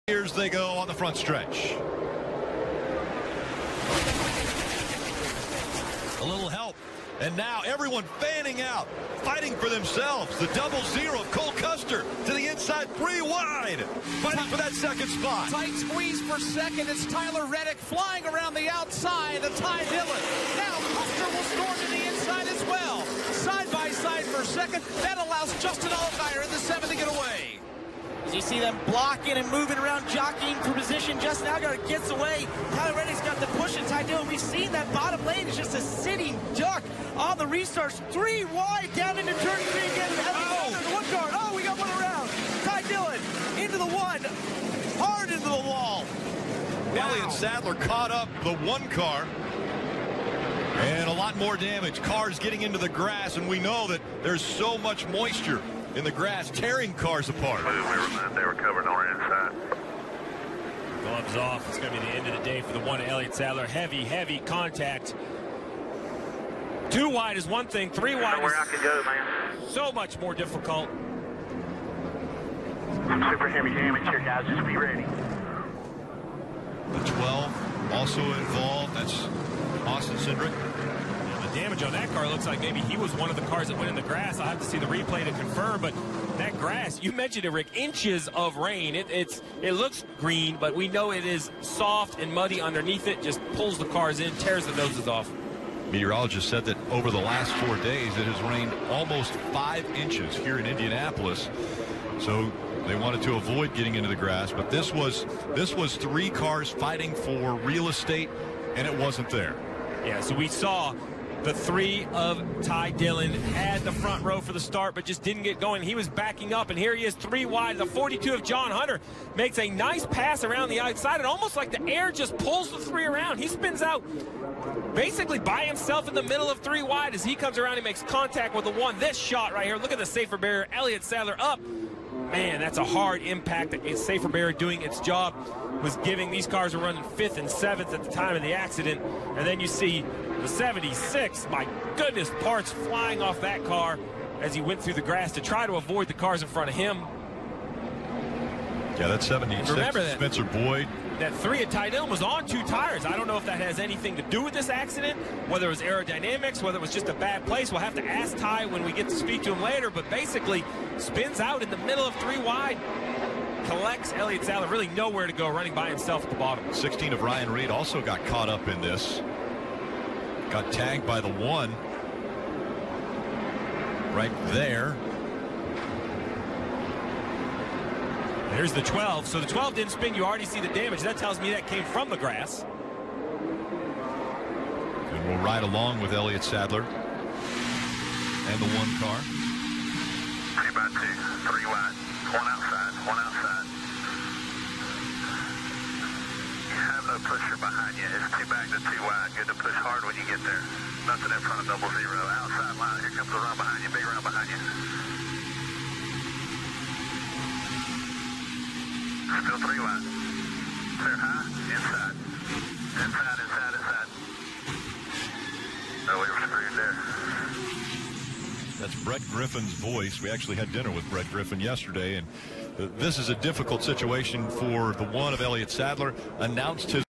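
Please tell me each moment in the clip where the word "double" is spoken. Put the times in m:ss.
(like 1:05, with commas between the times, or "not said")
0:10, 3:21.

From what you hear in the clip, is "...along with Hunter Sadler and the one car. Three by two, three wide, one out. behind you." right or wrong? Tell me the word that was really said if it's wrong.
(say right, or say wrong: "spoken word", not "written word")
wrong: "Elliott", not "Hunter".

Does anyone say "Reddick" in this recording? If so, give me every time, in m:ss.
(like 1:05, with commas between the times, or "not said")
0:17, 0:32.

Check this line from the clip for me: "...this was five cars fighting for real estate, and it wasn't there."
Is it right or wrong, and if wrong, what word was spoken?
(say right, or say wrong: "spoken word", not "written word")
wrong: "three", not "five".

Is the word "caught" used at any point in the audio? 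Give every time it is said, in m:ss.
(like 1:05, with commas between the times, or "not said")
0:47, 2:48.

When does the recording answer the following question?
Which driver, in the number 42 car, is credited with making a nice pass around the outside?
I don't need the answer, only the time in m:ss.
1:58.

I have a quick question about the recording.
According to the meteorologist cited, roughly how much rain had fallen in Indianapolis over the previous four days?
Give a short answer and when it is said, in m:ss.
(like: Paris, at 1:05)
almost 5 inches, at 1:38.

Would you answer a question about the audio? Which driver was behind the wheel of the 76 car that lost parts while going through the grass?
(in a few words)
Spencer Boyd.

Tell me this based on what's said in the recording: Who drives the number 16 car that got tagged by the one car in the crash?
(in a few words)
Ryan Reed.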